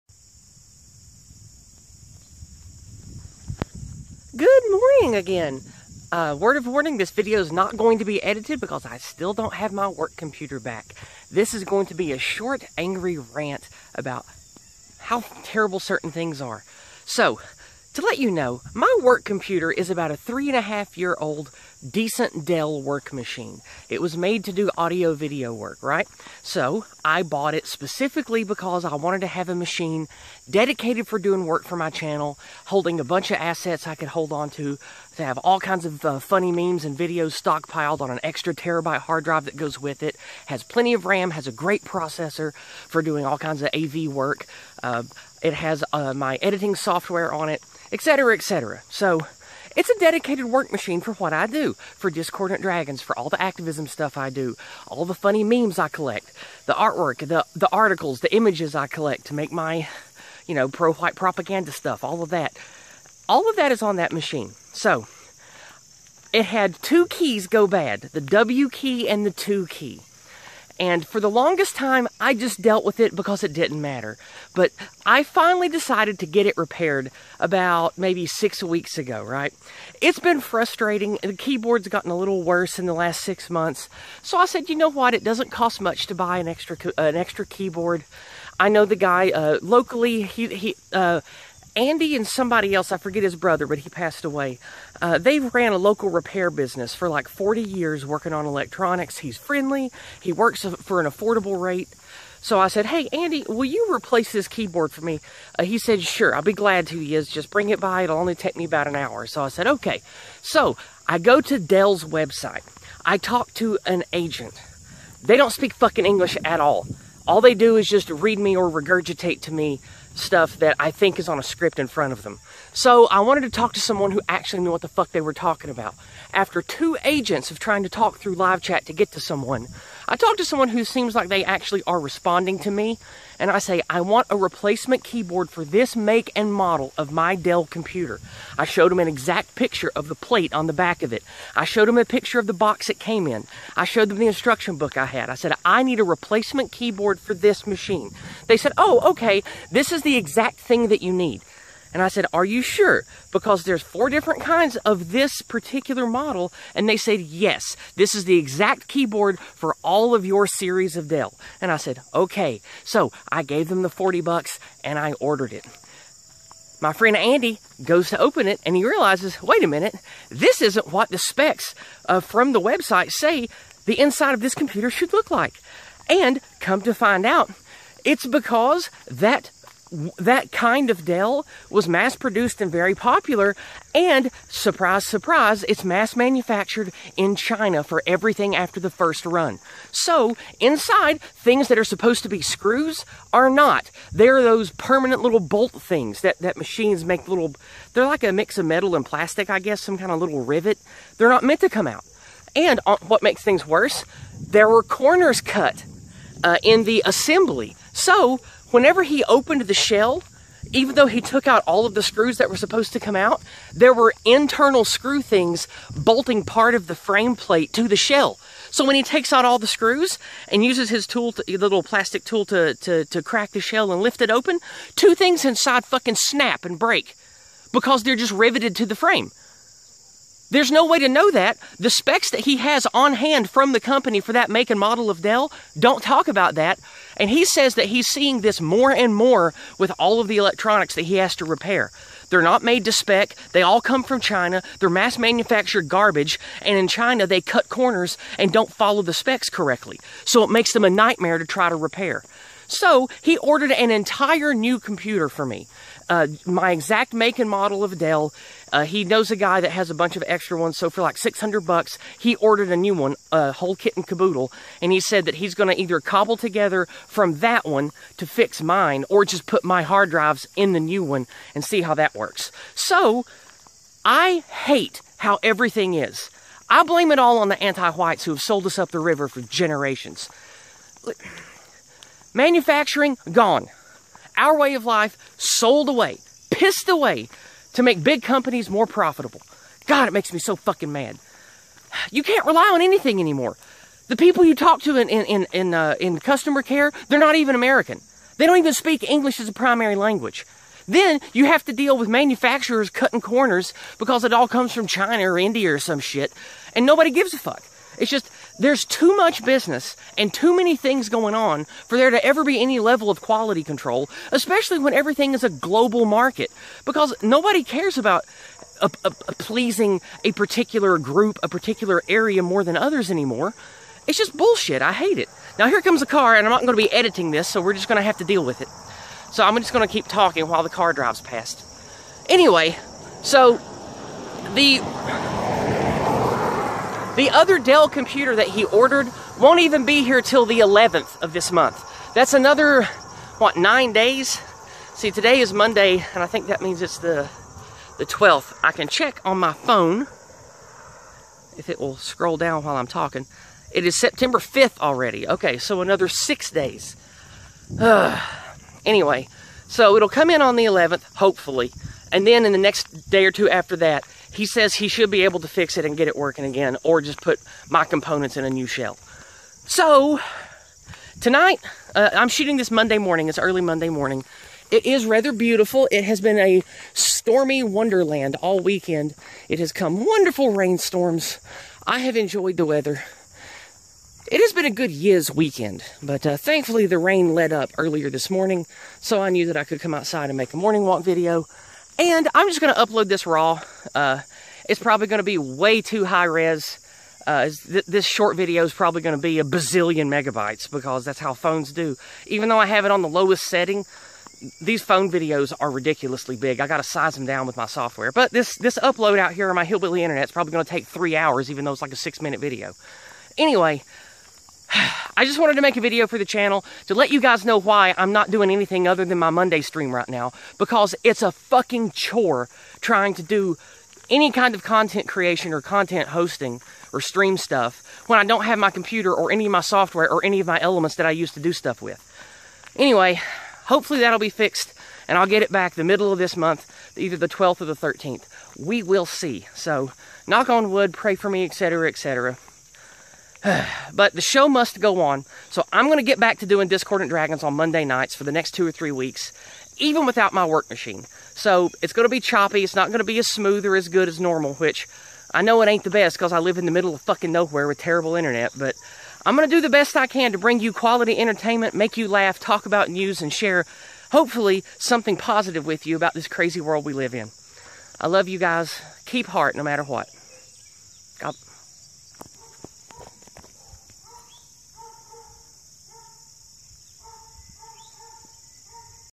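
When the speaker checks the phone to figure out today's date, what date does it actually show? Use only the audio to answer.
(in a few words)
September 5.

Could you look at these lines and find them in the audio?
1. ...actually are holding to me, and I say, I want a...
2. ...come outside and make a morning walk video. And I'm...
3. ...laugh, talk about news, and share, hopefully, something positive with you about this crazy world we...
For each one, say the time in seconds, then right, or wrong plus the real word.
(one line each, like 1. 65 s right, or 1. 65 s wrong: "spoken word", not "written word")
1. 131 s wrong: "responding", not "holding"
2. 389 s right
3. 462 s right.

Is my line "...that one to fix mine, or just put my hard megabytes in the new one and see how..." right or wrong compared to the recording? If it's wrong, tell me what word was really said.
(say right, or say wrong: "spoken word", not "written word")
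wrong: "drives", not "megabytes".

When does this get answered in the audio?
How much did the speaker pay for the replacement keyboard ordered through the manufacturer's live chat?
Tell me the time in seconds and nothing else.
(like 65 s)
163 s.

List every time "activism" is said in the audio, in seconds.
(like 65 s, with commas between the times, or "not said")
53 s.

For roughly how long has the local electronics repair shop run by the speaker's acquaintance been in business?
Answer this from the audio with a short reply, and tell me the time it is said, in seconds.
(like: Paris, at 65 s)
40 years, at 97 s.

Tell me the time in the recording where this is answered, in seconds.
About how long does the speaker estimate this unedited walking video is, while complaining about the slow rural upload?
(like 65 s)
412 s.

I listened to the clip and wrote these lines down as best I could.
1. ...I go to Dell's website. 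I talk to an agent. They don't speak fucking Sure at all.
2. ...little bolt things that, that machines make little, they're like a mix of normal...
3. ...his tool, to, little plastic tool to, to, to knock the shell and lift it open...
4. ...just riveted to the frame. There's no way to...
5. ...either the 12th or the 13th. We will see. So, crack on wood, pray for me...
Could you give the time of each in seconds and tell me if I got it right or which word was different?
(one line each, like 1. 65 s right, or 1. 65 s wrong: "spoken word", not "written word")
1. 111 s wrong: "English", not "Sure"
2. 195 s wrong: "metal", not "normal"
3. 220 s wrong: "crack", not "knock"
4. 228 s right
5. 436 s wrong: "knock", not "crack".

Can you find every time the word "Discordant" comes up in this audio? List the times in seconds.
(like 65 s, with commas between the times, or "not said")
52 s, 446 s.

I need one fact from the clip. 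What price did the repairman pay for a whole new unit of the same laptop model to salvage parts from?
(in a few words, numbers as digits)
$600.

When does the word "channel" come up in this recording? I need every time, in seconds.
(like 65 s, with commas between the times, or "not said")
31 s, 416 s.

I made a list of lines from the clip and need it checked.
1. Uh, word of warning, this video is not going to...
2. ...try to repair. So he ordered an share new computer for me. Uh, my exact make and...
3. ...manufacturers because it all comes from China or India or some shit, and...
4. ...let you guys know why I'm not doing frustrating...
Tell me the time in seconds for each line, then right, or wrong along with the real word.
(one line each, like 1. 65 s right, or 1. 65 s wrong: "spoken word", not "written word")
1. 6 s right
2. 251 s wrong: "entire", not "share"
3. 303 s wrong: "corners", not "manufacturers"
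4. 416 s wrong: "anything", not "frustrating".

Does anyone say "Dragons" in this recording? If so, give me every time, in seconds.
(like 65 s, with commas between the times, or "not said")
52 s, 447 s.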